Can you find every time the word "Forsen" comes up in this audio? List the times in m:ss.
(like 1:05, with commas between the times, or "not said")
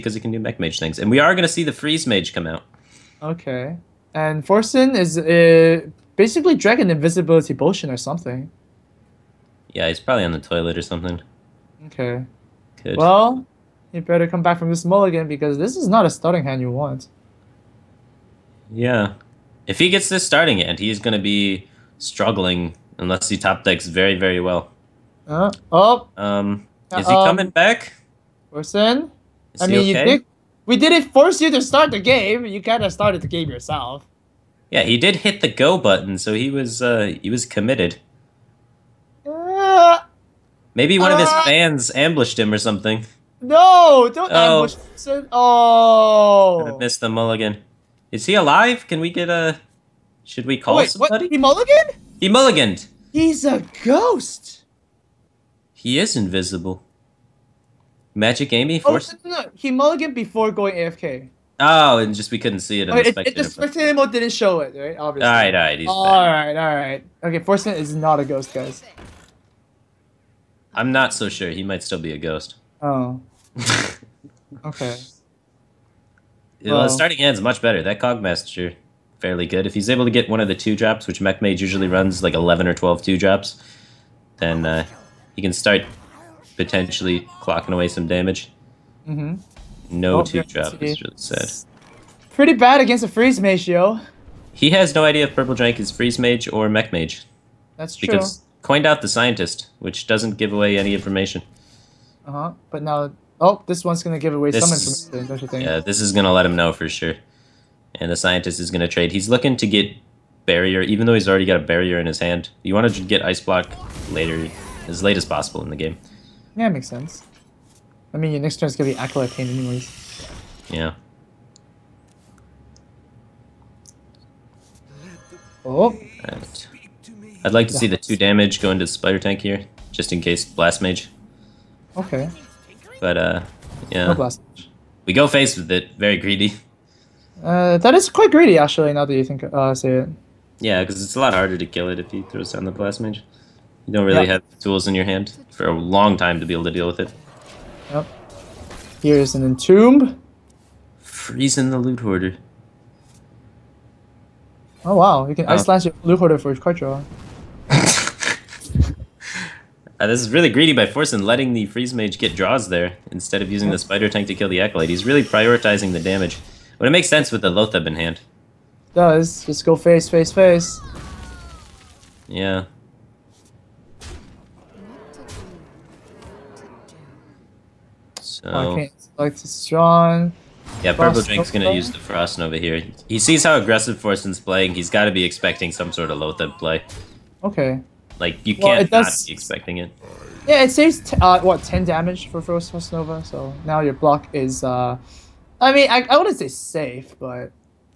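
0:04, 3:03.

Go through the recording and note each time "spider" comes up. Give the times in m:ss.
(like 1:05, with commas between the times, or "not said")
2:08, 2:43.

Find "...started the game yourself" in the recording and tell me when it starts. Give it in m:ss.
0:32.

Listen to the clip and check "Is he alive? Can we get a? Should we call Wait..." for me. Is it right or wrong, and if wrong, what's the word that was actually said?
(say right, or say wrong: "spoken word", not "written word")
right.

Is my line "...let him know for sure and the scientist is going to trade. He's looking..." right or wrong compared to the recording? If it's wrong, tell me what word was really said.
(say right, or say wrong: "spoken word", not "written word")
right.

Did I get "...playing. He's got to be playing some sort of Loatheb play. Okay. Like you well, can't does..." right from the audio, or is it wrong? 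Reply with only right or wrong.
wrong.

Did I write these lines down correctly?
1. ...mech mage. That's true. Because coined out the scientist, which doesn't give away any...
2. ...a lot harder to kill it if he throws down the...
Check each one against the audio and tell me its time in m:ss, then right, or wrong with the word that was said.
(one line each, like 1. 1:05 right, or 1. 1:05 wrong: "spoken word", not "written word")
1. 1:36 right
2. 2:21 right.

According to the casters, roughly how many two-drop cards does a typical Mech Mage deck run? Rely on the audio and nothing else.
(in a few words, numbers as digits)
11 or 12.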